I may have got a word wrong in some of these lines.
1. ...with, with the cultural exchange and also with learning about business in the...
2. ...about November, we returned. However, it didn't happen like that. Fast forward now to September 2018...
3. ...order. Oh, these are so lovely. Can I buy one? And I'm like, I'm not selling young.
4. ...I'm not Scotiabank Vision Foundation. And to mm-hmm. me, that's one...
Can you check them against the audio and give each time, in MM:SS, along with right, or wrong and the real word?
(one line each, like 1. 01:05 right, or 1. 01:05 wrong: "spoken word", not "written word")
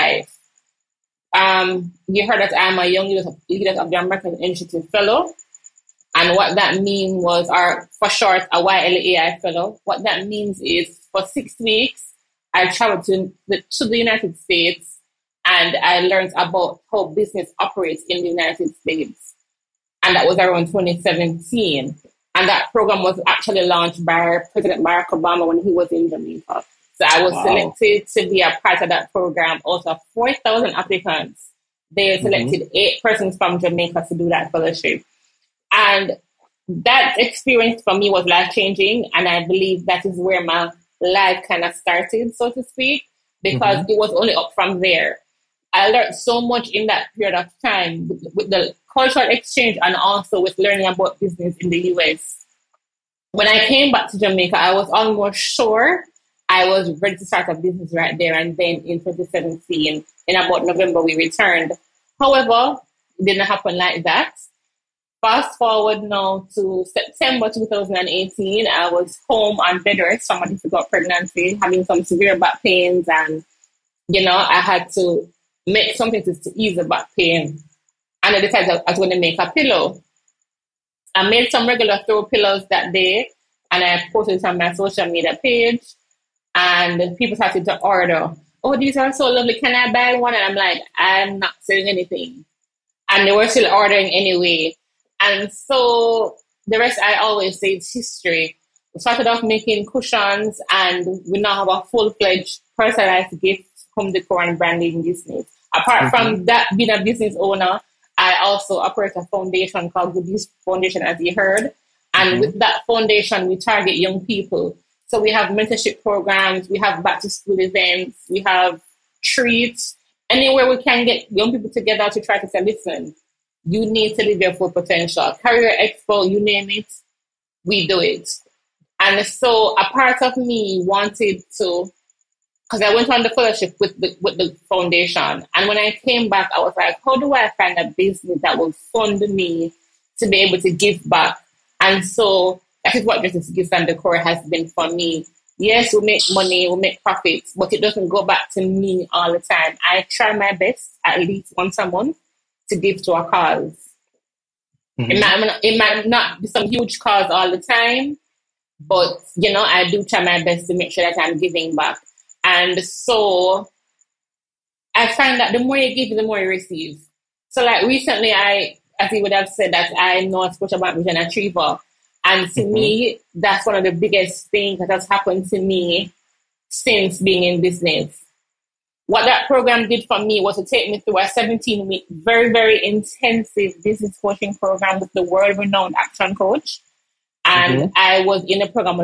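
1. 00:48 right
2. 01:00 right
3. 01:27 wrong: "anything", not "young"
4. 02:49 wrong: "Achiever", not "Foundation".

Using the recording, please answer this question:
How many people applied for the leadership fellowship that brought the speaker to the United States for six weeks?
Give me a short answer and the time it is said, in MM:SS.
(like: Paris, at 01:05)
4,000, at 00:30.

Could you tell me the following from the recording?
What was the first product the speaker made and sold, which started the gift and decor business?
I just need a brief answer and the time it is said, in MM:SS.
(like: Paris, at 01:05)
Cushions, at 01:39.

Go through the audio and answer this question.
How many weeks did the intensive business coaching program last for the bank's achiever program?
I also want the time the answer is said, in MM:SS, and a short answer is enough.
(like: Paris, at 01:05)
17, at 03:01.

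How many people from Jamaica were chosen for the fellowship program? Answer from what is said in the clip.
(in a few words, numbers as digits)
8.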